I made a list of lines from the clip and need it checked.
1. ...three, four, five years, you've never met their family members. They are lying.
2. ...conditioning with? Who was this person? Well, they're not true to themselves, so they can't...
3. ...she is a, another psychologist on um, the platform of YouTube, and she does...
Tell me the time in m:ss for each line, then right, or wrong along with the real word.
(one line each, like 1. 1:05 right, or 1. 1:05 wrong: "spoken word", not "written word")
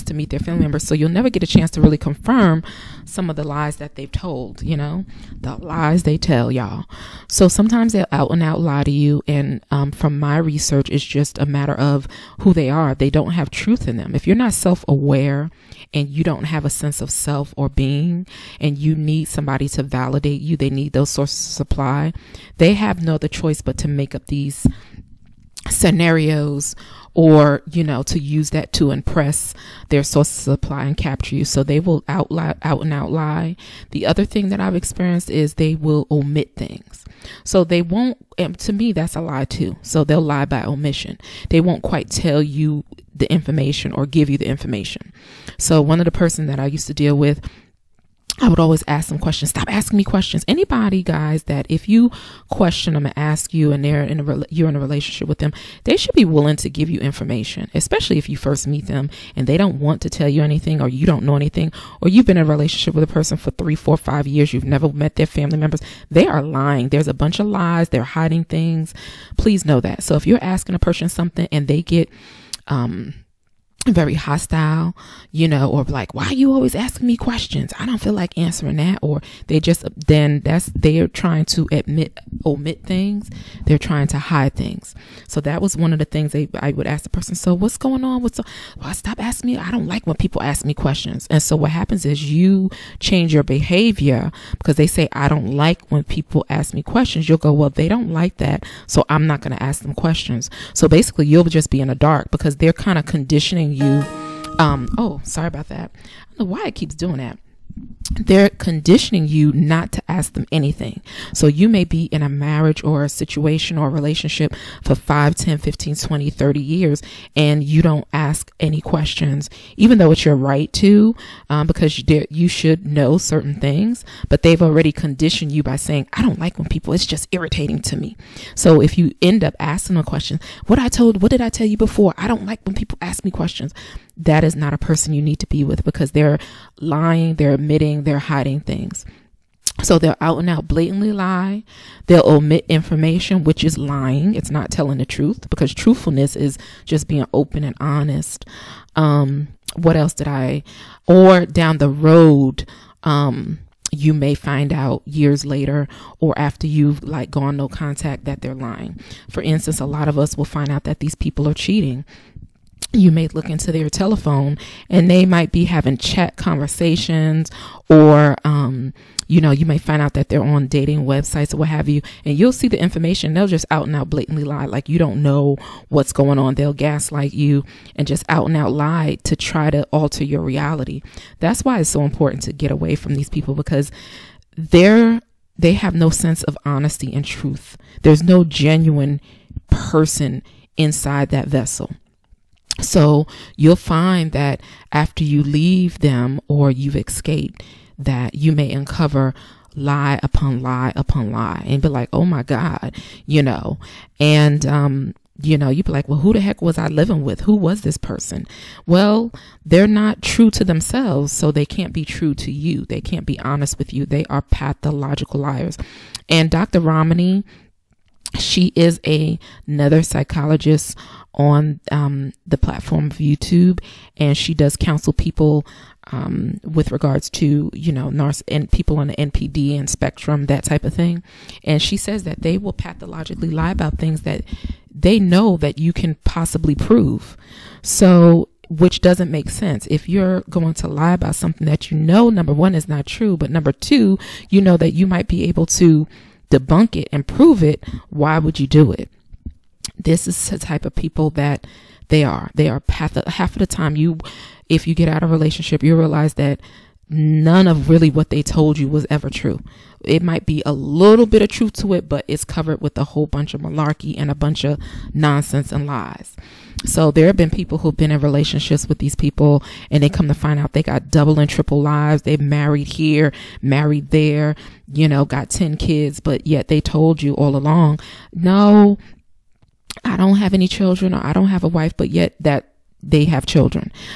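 1. 1:03 right
2. 3:26 wrong: "living", not "conditioning"
3. 3:38 right.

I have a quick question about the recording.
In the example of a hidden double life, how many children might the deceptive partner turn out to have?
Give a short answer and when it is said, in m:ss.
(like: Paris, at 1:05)
10, at 4:35.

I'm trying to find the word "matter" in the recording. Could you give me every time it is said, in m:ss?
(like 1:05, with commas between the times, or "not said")
0:11.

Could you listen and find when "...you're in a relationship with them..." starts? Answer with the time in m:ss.
0:54.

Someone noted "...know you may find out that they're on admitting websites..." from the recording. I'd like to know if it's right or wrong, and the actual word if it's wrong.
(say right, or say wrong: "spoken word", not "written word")
wrong: "dating", not "admitting".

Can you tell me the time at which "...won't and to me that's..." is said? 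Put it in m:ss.
0:37.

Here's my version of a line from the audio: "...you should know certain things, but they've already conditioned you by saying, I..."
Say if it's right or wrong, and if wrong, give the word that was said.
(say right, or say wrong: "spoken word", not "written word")
right.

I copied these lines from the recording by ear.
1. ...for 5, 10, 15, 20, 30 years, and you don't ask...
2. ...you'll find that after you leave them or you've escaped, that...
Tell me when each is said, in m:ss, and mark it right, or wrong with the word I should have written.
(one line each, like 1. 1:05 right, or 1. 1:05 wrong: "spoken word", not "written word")
1. 1:54 right
2. 3:13 right.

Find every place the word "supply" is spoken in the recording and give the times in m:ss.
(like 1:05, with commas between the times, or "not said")
0:21, 0:30.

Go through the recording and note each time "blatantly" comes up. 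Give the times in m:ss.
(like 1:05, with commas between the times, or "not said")
2:20, 2:54.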